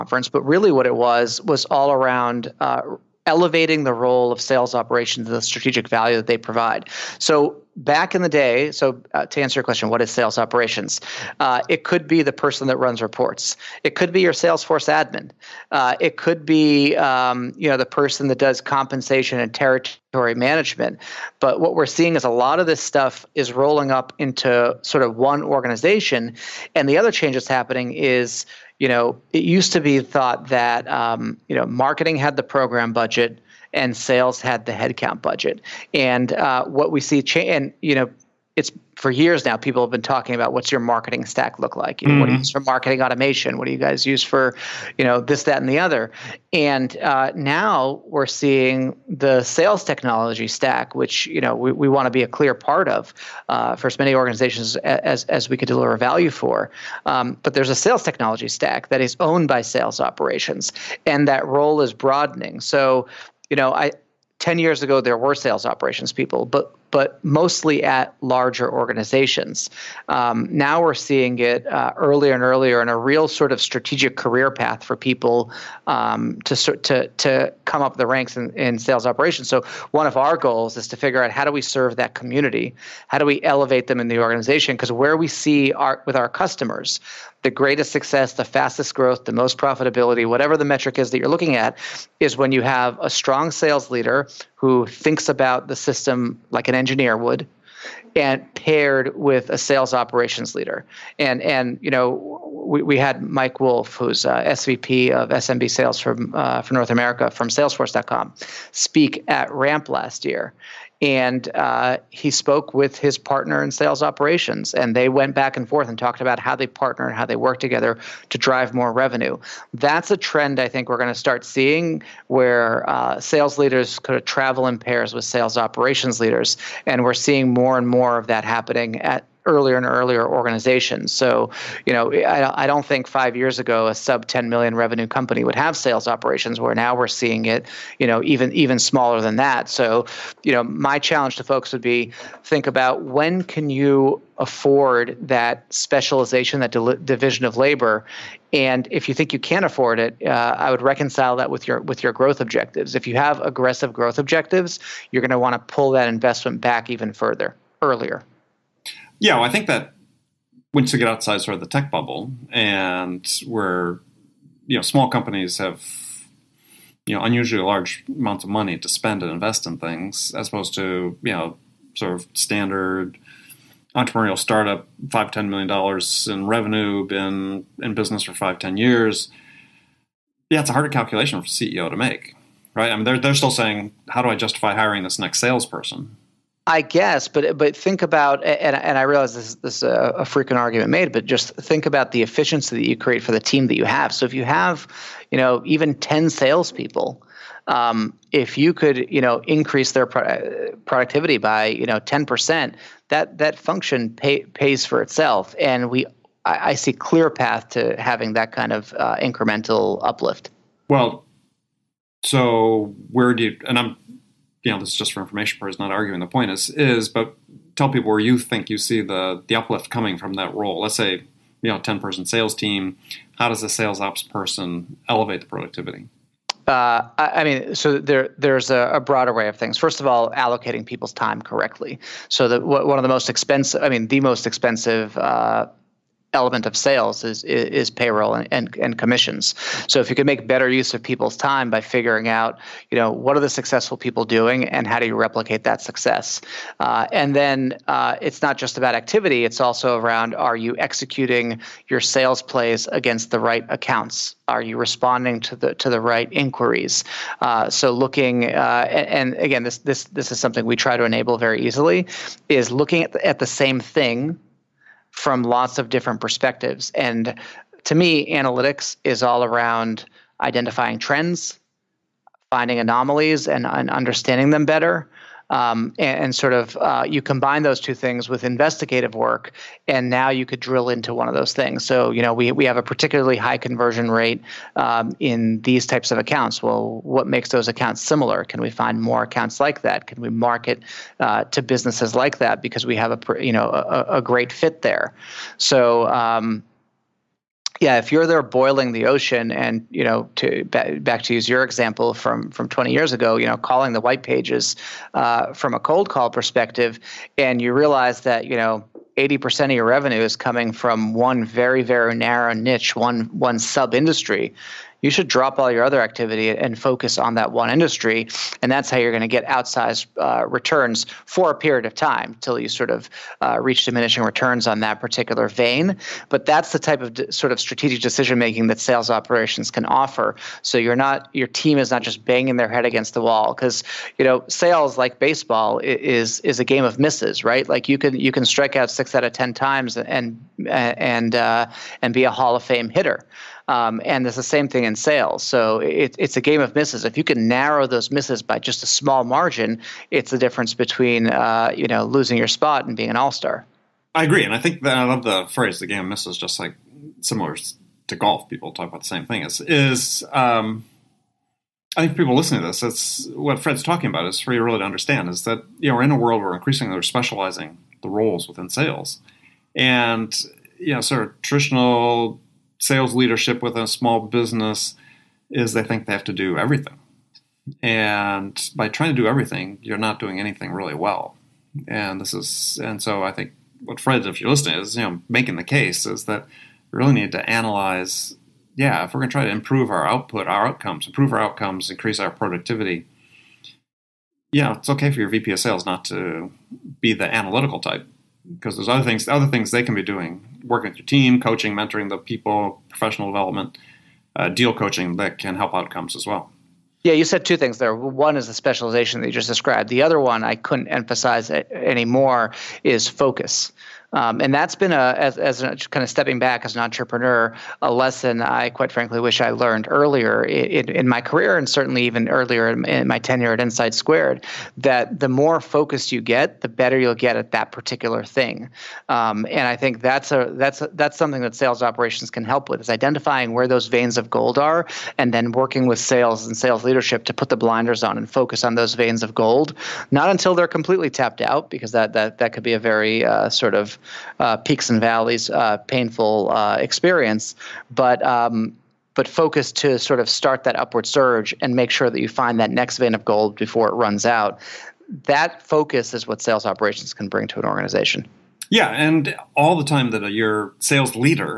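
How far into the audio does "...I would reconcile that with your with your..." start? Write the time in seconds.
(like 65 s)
150 s.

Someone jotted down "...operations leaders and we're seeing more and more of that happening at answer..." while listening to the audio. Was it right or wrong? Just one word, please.
wrong.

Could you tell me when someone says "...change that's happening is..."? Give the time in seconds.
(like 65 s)
27 s.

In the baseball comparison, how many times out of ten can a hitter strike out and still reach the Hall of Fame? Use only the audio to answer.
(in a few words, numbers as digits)
6.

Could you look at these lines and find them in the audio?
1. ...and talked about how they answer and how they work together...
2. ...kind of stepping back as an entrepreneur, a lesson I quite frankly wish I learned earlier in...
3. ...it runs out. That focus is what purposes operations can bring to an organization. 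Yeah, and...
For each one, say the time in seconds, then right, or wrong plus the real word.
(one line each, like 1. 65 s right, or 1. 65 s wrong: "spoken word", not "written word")
1. 115 s wrong: "partner", not "answer"
2. 415 s right
3. 453 s wrong: "sales", not "purposes".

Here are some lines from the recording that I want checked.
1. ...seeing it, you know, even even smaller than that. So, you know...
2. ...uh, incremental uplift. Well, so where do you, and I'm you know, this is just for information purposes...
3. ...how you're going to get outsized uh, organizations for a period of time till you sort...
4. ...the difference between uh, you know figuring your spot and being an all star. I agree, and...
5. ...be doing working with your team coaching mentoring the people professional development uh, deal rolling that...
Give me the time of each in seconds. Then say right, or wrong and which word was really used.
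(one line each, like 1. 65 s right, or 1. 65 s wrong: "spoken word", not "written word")
1. 137 s right
2. 208 s right
3. 318 s wrong: "returns", not "organizations"
4. 350 s wrong: "losing", not "figuring"
5. 399 s wrong: "coaching", not "rolling".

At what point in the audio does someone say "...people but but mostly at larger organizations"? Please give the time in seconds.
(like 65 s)
66 s.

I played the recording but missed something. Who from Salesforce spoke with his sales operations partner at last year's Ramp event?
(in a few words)
Mike Wolf.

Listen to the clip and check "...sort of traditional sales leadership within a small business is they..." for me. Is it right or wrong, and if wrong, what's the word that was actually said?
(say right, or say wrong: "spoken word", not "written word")
right.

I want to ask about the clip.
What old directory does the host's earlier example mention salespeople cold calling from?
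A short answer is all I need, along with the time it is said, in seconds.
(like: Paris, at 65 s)
the white pages, at 303 s.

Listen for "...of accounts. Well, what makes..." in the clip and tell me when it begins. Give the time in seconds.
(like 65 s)
286 s.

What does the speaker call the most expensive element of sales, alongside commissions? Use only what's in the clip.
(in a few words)
payroll.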